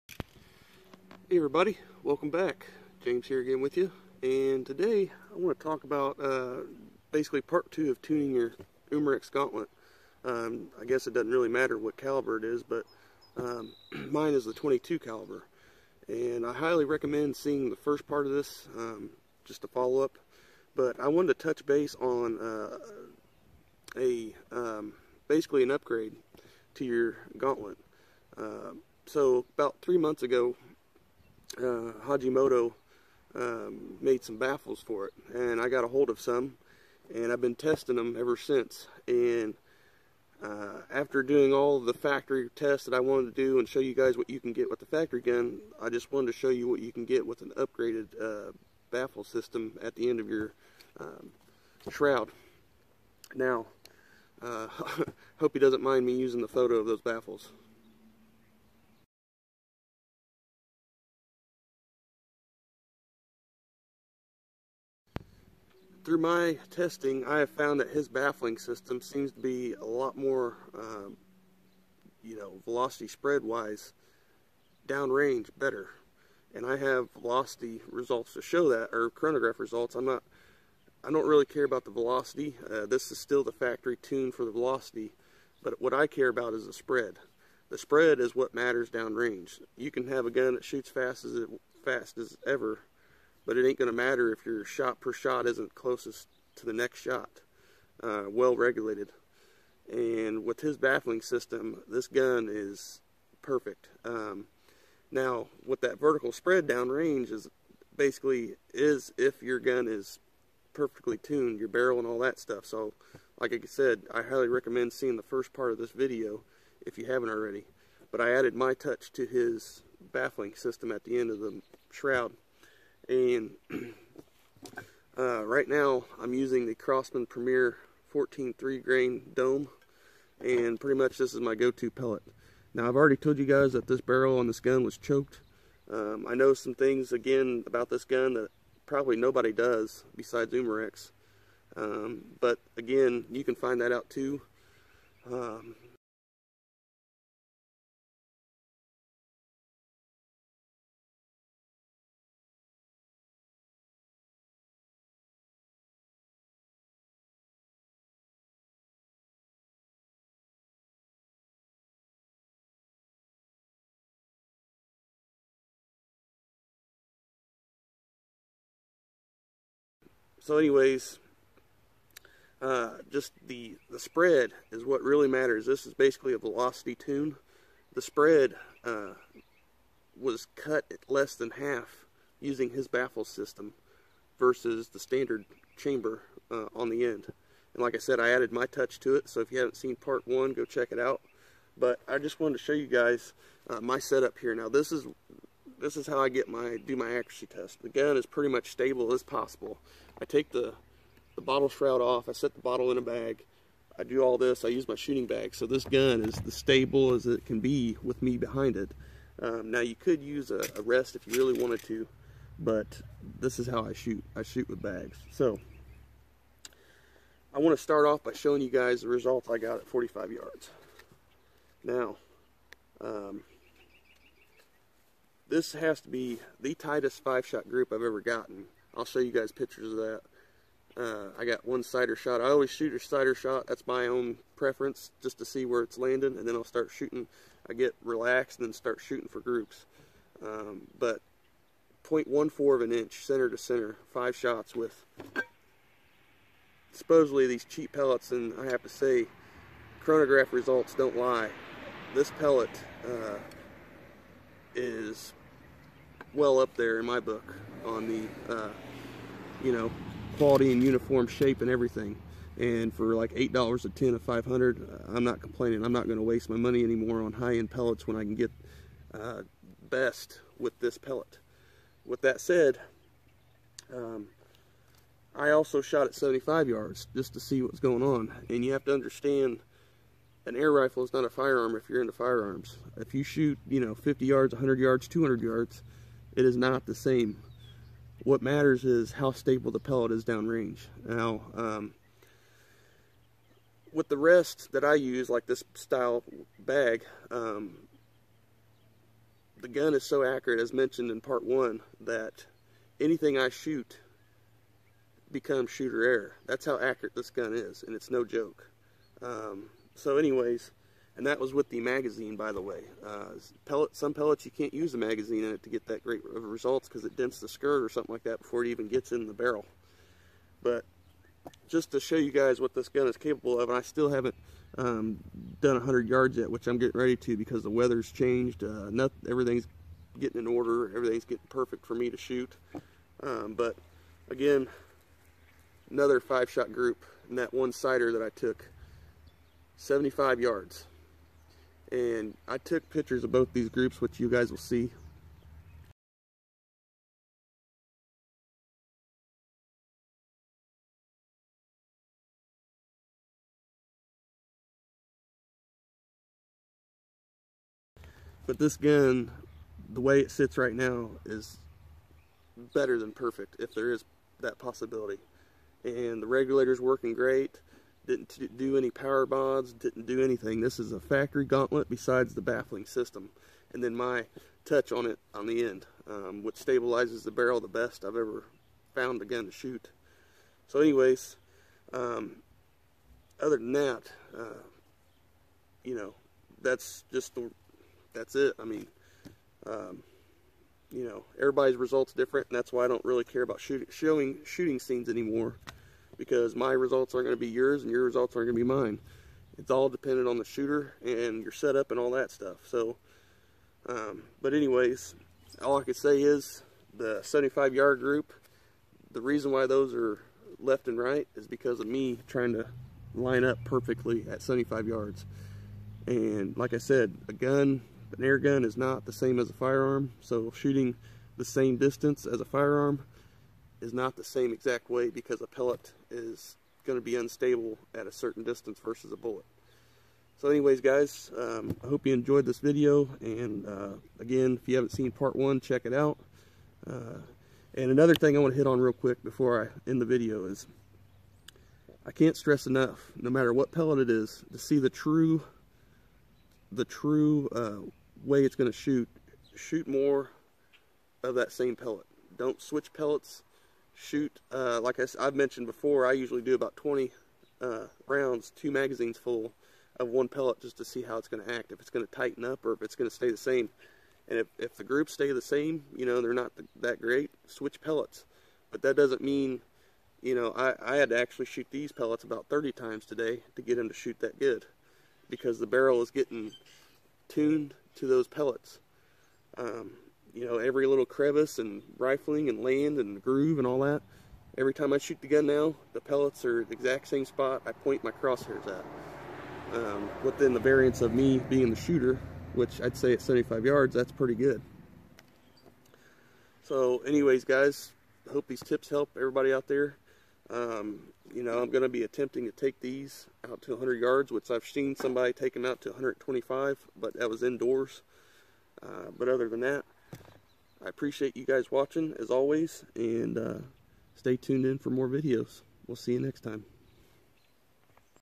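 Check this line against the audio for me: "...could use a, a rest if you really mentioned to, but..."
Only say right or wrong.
wrong.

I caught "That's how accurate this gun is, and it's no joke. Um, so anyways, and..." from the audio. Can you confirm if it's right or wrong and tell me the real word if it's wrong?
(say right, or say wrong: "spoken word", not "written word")
right.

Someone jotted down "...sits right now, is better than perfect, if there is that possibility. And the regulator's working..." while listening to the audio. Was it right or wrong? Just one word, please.
right.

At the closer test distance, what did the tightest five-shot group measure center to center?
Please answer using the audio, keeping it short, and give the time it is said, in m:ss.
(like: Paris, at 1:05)
0.14 inch, at 4:02.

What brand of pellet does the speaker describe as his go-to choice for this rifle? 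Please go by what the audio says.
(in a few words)
Crossman Premier.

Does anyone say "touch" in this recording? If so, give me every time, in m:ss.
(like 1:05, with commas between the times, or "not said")
0:21, 1:58, 3:08, 6:14.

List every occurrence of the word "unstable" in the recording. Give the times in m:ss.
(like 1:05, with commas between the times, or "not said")
7:07.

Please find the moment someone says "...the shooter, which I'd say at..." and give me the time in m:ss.
8:11.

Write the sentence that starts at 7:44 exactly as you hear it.
And if, if the groups stay the same, you know, they're not th that great, switch pellets.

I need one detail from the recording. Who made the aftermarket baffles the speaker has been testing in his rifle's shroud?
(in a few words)
Hajimoto.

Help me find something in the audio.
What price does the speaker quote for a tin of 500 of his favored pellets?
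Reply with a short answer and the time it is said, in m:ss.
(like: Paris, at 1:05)
$8, at 4:23.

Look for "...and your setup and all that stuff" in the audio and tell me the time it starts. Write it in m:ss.
6:41.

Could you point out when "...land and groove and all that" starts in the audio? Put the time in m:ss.
8:02.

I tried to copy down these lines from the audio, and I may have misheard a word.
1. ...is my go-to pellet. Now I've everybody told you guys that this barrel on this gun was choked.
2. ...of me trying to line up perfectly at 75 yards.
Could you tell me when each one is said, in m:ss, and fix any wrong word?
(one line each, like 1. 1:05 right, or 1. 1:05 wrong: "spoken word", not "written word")
1. 2:11 wrong: "already", not "everybody"
2. 6:51 right.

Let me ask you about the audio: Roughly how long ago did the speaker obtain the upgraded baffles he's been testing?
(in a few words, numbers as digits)
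3 months.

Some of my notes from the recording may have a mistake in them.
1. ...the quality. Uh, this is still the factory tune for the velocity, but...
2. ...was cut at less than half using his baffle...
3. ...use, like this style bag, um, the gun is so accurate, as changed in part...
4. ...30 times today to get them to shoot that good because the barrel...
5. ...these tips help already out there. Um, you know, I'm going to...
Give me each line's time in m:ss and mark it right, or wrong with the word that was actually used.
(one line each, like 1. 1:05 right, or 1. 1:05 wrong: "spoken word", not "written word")
1. 1:21 wrong: "velocity", not "quality"
2. 3:00 right
3. 4:54 wrong: "mentioned", not "changed"
4. 7:52 right
5. 8:18 wrong: "everybody", not "already".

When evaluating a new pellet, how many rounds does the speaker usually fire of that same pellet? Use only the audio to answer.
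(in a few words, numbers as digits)
20.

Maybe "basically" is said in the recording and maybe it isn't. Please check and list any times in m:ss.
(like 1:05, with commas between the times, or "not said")
0:07, 0:25, 1:47, 2:55.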